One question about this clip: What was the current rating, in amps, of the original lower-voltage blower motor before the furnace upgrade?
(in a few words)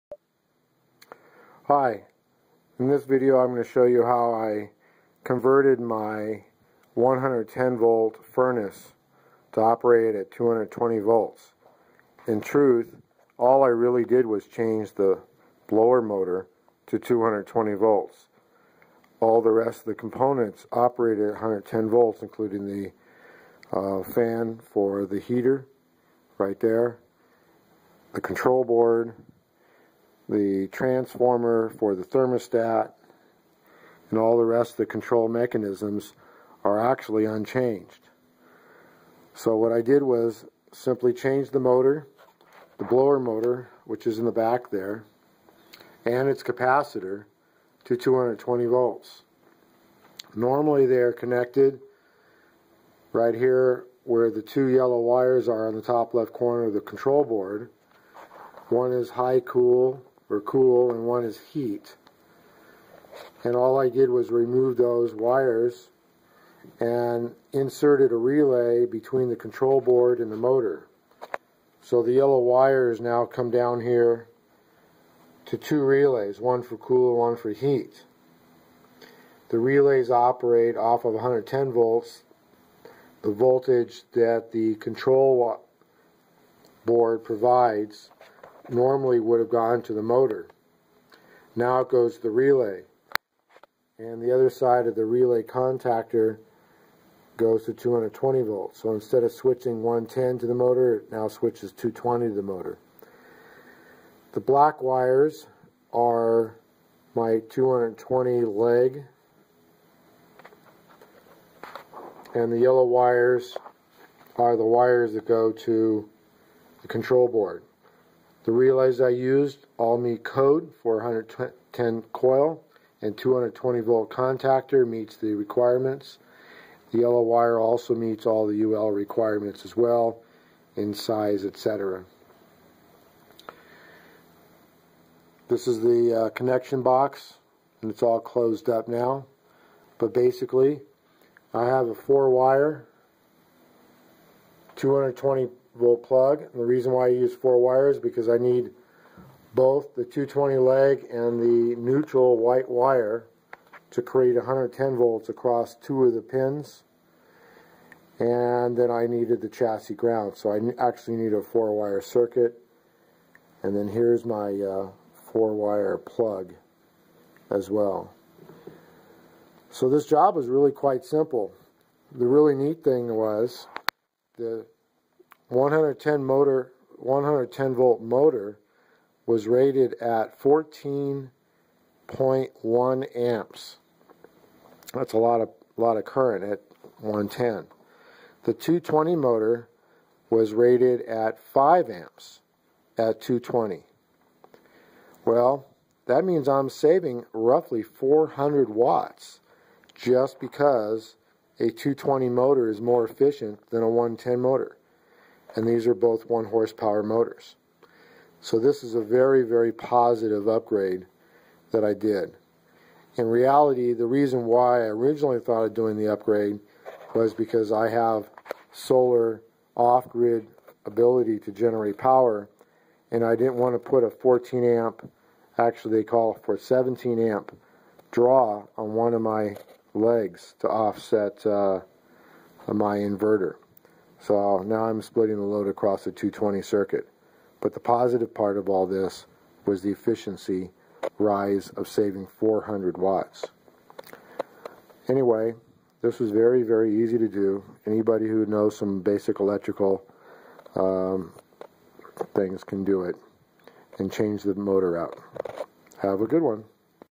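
14.1 amps.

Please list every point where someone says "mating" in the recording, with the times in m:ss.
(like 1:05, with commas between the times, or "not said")
not said.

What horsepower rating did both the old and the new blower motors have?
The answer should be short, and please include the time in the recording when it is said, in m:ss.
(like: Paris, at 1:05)
1 horsepower, at 3:26.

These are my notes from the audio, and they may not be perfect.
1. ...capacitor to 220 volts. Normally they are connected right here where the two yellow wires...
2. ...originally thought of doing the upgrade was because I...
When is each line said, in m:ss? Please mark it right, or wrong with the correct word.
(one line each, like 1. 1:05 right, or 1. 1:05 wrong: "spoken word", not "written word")
1. 0:46 right
2. 3:34 right.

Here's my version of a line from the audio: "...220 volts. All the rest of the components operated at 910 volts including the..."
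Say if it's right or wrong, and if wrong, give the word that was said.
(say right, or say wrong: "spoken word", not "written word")
wrong: "110", not "910".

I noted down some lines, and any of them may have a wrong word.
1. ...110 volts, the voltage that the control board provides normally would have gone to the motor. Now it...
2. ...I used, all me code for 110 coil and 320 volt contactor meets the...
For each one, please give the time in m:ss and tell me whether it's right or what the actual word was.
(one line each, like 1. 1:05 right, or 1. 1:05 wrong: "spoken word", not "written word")
1. 1:21 right
2. 1:58 wrong: "220", not "320".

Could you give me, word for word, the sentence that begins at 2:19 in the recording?
But basically, I have a four wire 220 volt plug.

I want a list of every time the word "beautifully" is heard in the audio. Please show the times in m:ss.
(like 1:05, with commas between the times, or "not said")
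not said.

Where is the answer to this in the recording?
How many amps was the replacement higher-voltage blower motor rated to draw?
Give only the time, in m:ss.
3:11.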